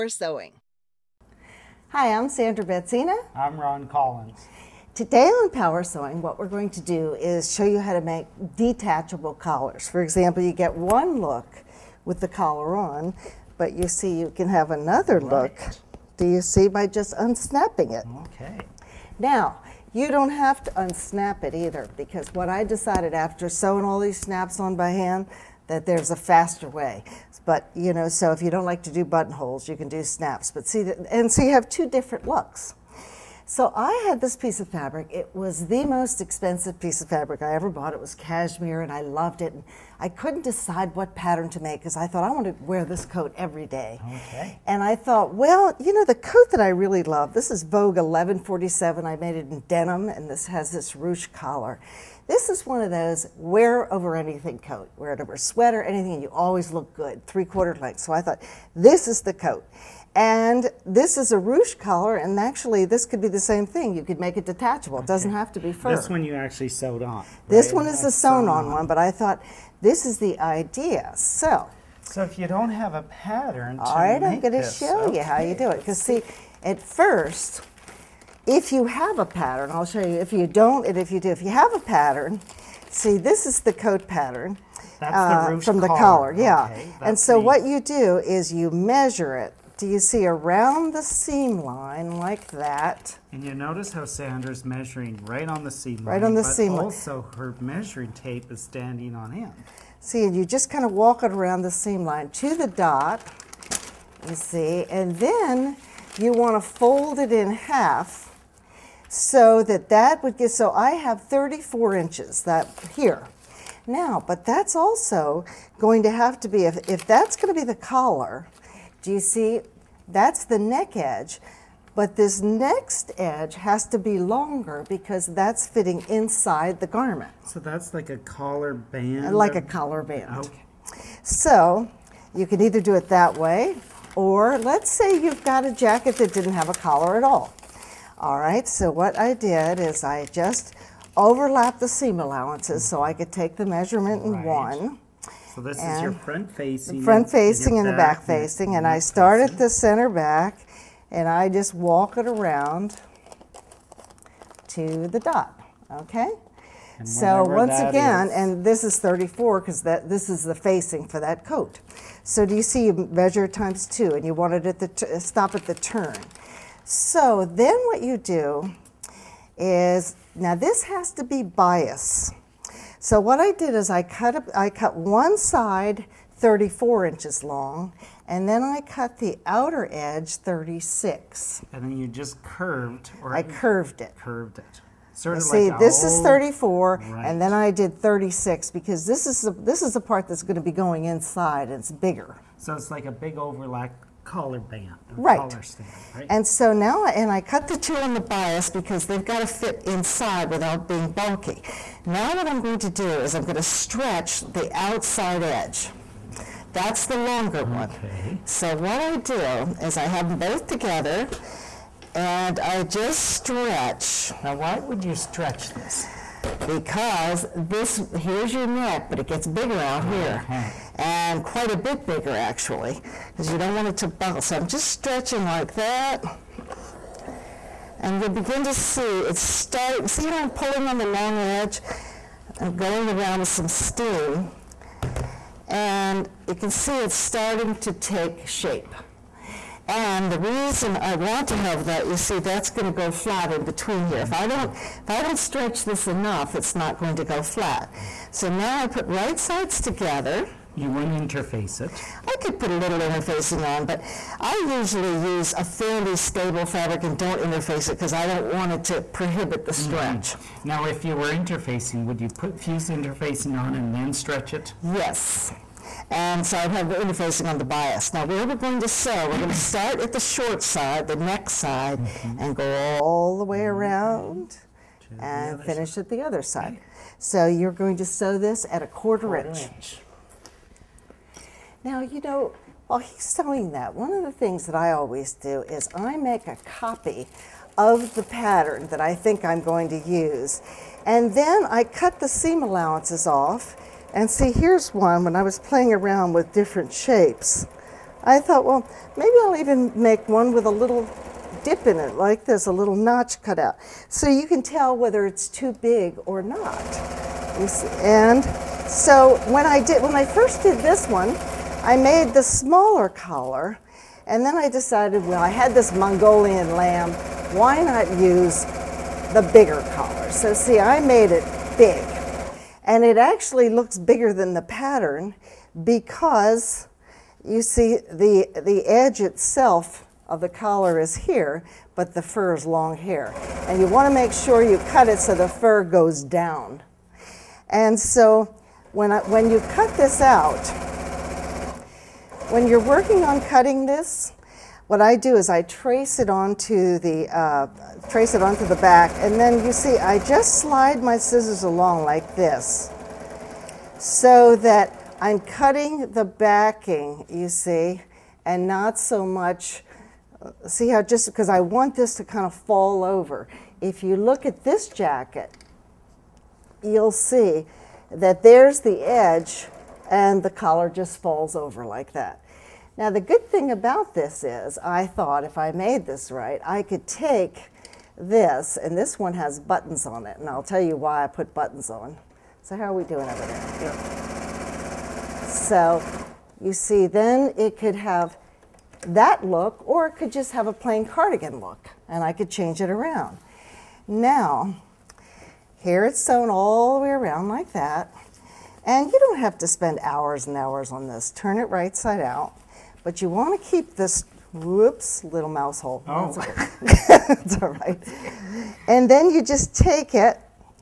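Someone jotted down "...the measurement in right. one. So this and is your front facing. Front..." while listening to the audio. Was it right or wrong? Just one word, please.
right.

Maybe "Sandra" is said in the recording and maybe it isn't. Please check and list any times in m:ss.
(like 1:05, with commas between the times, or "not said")
0:02, 1:34.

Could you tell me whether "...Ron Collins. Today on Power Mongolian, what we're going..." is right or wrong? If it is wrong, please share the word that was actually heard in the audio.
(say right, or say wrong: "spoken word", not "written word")
wrong: "Sewing", not "Mongolian".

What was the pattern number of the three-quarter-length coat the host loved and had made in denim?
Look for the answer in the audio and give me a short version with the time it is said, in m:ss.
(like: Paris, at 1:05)
Vogue 1147, at 0:47.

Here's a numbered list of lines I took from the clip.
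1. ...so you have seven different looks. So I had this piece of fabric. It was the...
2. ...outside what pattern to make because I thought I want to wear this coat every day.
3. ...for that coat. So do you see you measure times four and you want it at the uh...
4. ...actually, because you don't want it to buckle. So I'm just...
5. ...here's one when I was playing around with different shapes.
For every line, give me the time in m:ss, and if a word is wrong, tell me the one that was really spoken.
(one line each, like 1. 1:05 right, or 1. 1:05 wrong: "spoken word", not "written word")
1. 0:31 wrong: "two", not "seven"
2. 0:40 wrong: "decide", not "outside"
3. 2:41 wrong: "two", not "four"
4. 3:42 right
5. 4:54 right.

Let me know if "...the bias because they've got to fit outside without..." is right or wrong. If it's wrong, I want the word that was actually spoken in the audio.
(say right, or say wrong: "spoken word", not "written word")
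wrong: "inside", not "outside".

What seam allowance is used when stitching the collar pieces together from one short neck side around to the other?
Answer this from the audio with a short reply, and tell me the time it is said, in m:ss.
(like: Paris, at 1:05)
quarter inch, at 4:39.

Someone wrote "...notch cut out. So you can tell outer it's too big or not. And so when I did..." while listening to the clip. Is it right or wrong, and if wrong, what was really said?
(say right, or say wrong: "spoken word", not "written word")
wrong: "whether", not "outer".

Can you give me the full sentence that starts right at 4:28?
Now, where we're going to sew, we're going to start at the short side, the neck side, mm -hmm.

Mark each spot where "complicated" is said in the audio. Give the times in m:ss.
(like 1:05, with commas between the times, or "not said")
not said.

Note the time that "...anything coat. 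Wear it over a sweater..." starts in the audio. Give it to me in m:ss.
0:54.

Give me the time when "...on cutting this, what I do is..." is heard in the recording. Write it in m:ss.
5:43.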